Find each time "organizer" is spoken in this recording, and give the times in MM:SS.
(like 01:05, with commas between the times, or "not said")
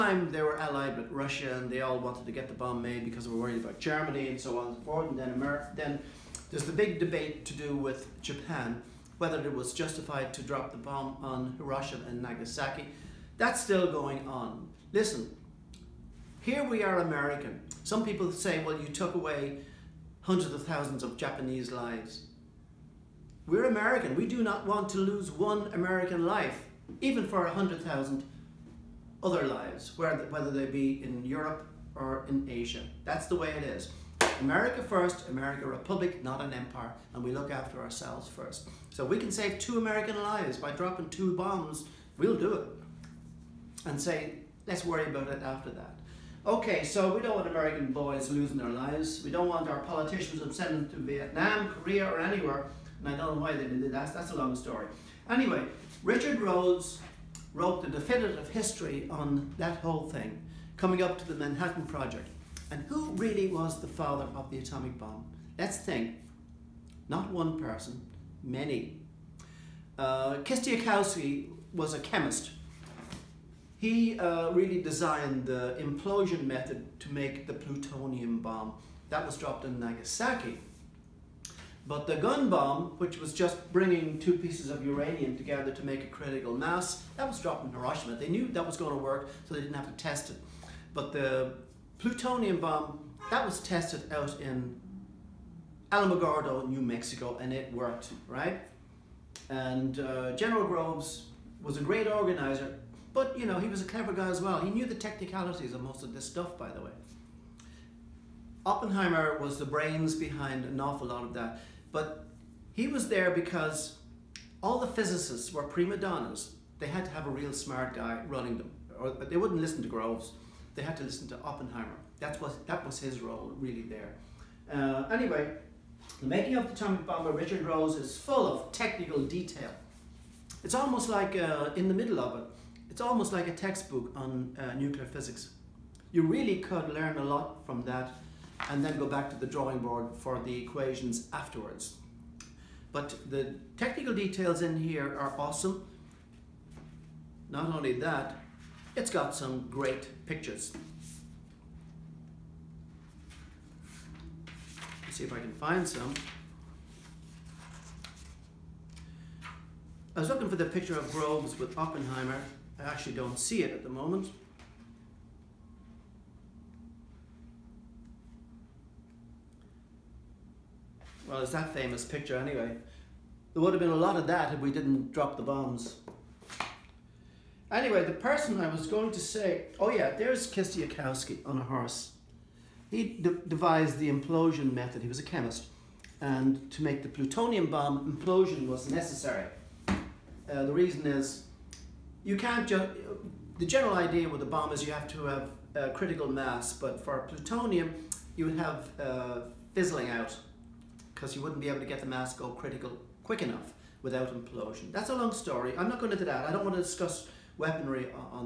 01:42.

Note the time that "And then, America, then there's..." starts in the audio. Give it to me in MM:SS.
00:05.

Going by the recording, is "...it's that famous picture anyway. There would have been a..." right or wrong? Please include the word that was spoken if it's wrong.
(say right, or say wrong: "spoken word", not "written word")
right.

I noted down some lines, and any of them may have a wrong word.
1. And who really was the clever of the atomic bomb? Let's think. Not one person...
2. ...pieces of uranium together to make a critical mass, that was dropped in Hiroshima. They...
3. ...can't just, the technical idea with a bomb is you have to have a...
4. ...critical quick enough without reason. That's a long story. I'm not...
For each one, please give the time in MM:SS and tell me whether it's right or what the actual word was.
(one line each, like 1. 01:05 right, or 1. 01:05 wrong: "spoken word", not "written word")
1. 01:02 wrong: "father", not "clever"
2. 01:24 right
3. 03:12 wrong: "general", not "technical"
4. 03:22 wrong: "implosion", not "reason".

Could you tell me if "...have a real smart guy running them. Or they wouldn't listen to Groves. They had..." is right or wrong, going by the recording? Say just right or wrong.
right.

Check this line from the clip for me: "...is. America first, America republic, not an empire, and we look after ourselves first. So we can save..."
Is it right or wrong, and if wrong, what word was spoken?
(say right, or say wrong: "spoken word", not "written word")
right.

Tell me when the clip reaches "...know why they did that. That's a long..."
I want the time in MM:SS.
00:53.